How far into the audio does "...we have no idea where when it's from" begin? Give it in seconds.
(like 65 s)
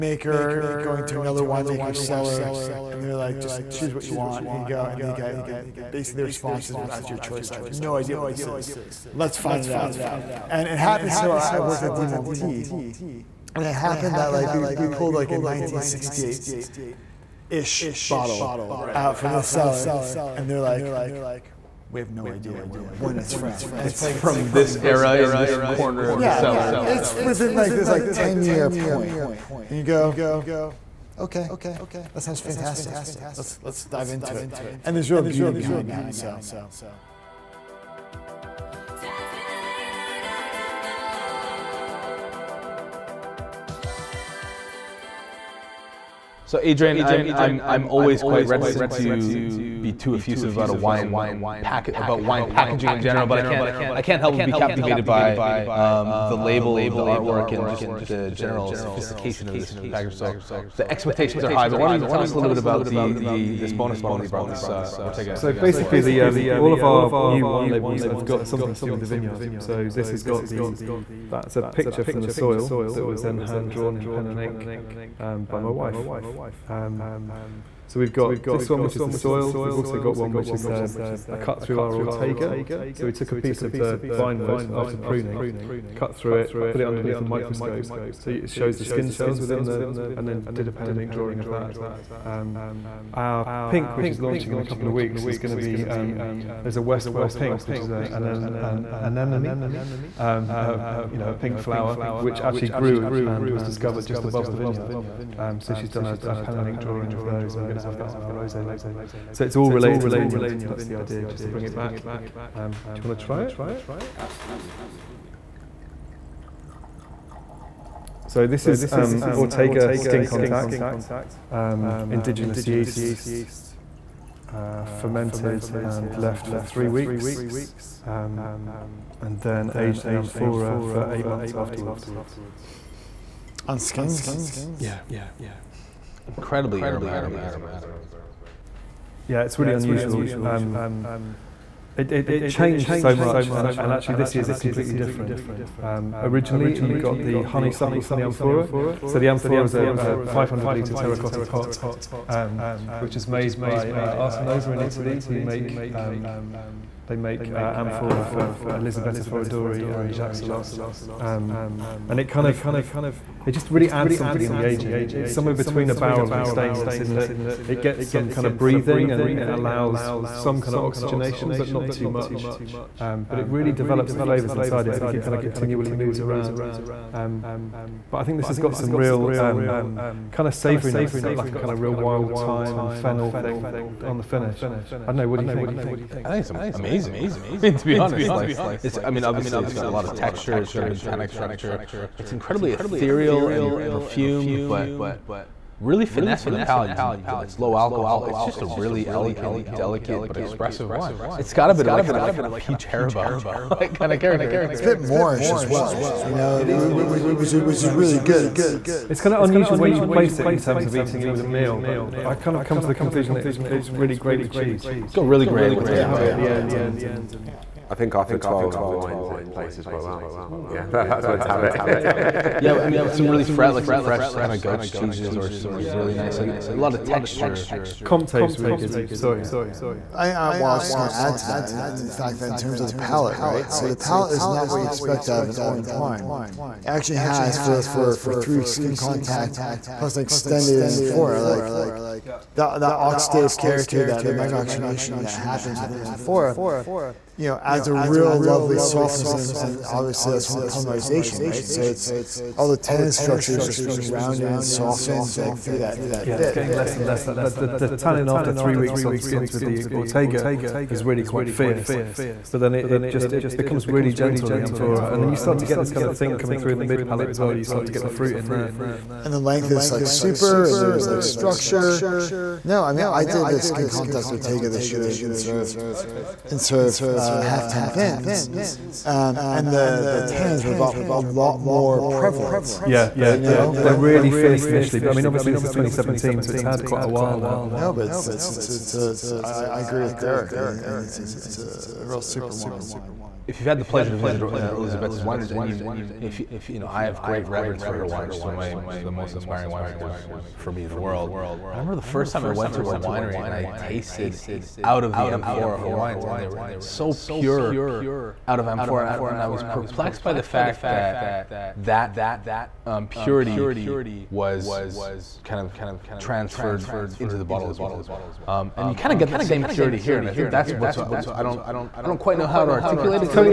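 21 s.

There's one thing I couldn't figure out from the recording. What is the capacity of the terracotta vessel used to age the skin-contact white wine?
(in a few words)
500 litres.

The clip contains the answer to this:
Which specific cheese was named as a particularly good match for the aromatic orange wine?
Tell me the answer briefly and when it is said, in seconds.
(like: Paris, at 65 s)
Comte, at 228 s.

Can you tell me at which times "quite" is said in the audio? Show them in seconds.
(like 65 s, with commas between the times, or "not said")
48 s, 219 s, 261 s, 286 s, 322 s.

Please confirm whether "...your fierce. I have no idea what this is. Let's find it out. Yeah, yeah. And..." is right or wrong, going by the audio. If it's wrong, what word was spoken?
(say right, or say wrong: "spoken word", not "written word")
wrong: "choice", not "fierce".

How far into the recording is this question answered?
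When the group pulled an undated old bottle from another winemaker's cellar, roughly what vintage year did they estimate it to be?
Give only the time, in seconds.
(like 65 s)
15 s.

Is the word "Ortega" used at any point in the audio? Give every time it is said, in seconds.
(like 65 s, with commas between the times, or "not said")
65 s, 81 s, 119 s, 259 s, 274 s.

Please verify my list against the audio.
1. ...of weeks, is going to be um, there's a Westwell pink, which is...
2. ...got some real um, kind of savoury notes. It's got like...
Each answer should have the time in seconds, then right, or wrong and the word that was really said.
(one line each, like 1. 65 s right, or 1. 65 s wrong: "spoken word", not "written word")
1. 94 s right
2. 178 s right.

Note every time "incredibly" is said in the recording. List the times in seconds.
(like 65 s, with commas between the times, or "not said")
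136 s, 192 s.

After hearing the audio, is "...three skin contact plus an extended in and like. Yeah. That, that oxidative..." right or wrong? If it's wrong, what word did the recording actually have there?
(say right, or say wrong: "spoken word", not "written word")
right.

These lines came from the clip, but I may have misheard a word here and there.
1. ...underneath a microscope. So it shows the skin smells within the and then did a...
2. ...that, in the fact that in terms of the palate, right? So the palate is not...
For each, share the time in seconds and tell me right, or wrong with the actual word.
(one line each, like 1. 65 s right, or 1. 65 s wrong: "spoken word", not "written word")
1. 86 s wrong: "cells", not "smells"
2. 231 s right.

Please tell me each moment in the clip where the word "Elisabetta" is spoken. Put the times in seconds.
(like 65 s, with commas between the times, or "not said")
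158 s, 294 s.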